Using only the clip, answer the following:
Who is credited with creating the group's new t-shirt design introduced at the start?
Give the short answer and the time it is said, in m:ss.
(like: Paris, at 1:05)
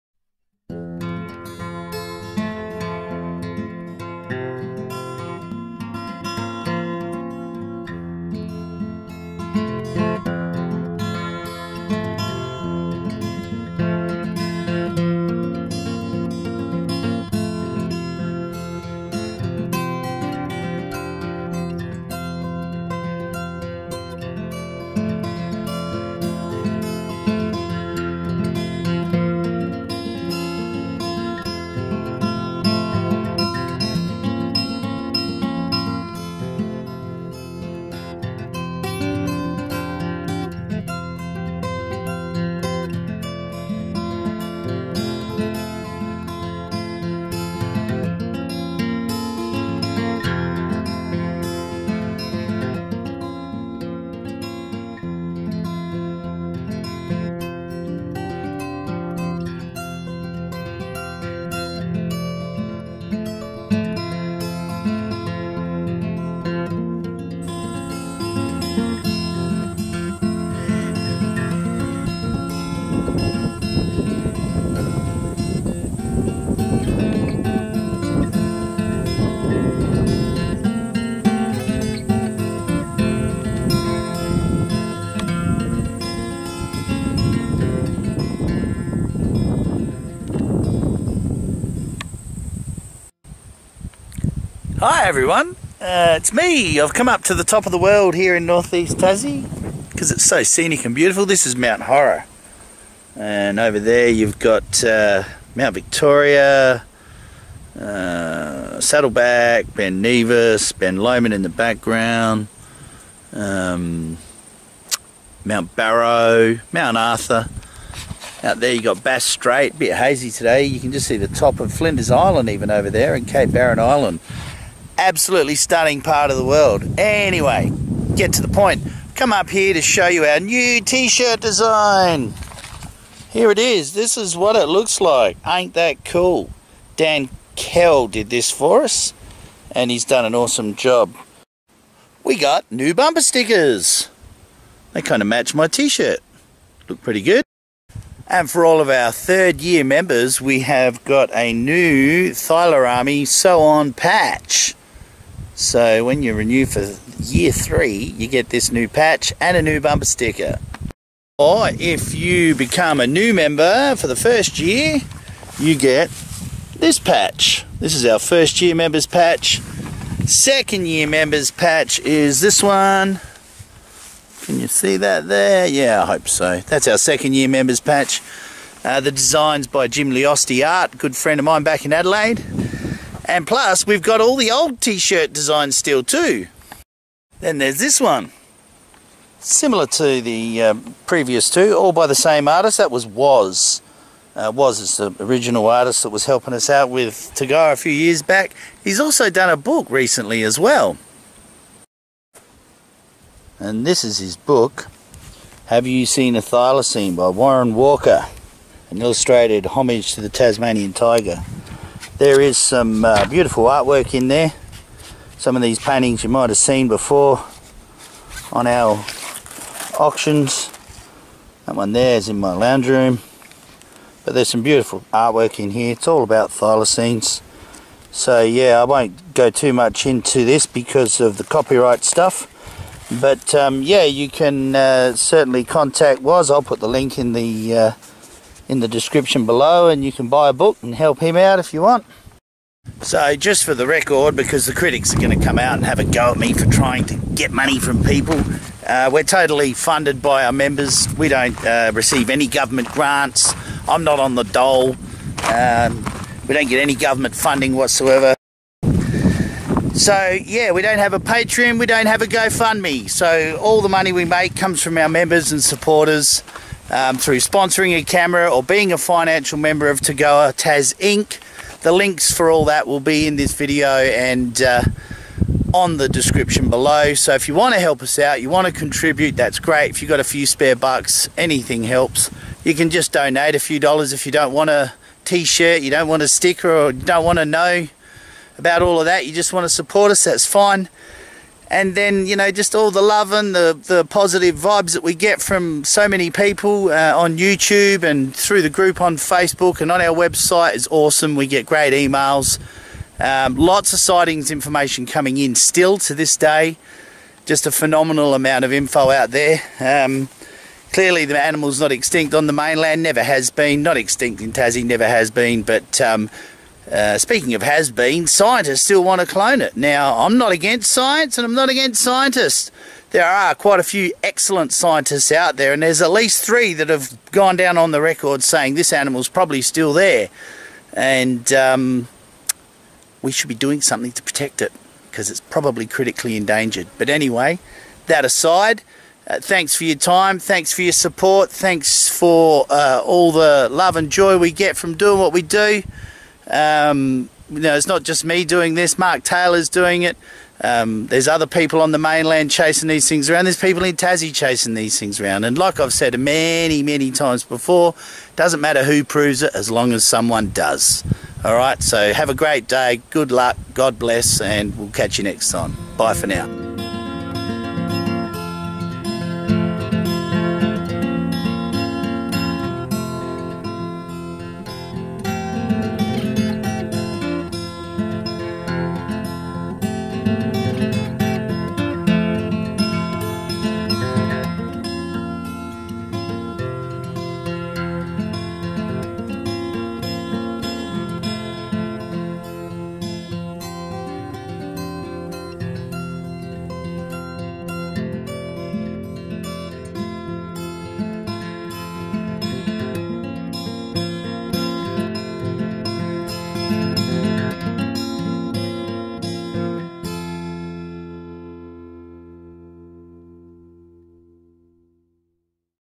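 Dan Kell, at 2:16.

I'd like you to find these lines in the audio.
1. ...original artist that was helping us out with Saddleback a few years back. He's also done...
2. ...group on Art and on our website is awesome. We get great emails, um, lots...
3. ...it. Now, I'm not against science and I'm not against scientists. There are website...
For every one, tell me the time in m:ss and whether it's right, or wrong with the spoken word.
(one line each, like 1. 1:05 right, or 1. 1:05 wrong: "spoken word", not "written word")
1. 3:15 wrong: "TAGOA", not "Saddleback"
2. 4:58 wrong: "Facebook", not "Art"
3. 5:19 wrong: "quite", not "website".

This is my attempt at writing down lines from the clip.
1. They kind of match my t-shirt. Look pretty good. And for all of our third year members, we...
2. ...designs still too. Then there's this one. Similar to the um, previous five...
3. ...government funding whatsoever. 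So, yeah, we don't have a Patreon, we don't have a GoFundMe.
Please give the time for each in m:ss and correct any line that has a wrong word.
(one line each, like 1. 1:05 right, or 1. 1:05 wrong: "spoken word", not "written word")
1. 2:24 right
2. 3:05 wrong: "two", not "five"
3. 4:16 right.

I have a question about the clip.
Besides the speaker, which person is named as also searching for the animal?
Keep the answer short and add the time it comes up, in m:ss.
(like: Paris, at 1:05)
Mark Taylor, at 5:48.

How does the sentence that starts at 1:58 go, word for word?
Out there you got Bass Strait, bit hazy today.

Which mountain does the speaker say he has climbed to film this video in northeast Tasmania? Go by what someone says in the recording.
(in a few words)
Mount Horror.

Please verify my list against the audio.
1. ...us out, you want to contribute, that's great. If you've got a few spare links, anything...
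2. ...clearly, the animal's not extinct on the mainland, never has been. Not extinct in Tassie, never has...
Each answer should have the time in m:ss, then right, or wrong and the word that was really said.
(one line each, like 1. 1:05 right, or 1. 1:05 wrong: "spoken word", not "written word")
1. 4:38 wrong: "bucks", not "links"
2. 5:10 right.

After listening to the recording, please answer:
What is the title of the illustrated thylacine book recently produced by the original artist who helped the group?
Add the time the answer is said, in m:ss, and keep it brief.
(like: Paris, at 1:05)
Have You Seen a Thylacine, at 3:25.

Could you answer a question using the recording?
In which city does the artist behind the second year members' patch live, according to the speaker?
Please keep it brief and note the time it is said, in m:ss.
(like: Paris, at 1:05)
Adelaide, at 3:01.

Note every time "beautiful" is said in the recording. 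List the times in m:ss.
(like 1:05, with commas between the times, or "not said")
1:40, 3:33, 3:44.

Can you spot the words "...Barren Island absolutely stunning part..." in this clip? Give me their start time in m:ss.
2:03.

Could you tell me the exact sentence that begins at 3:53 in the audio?
But um, yeah, you can uh, certainly contact WAS.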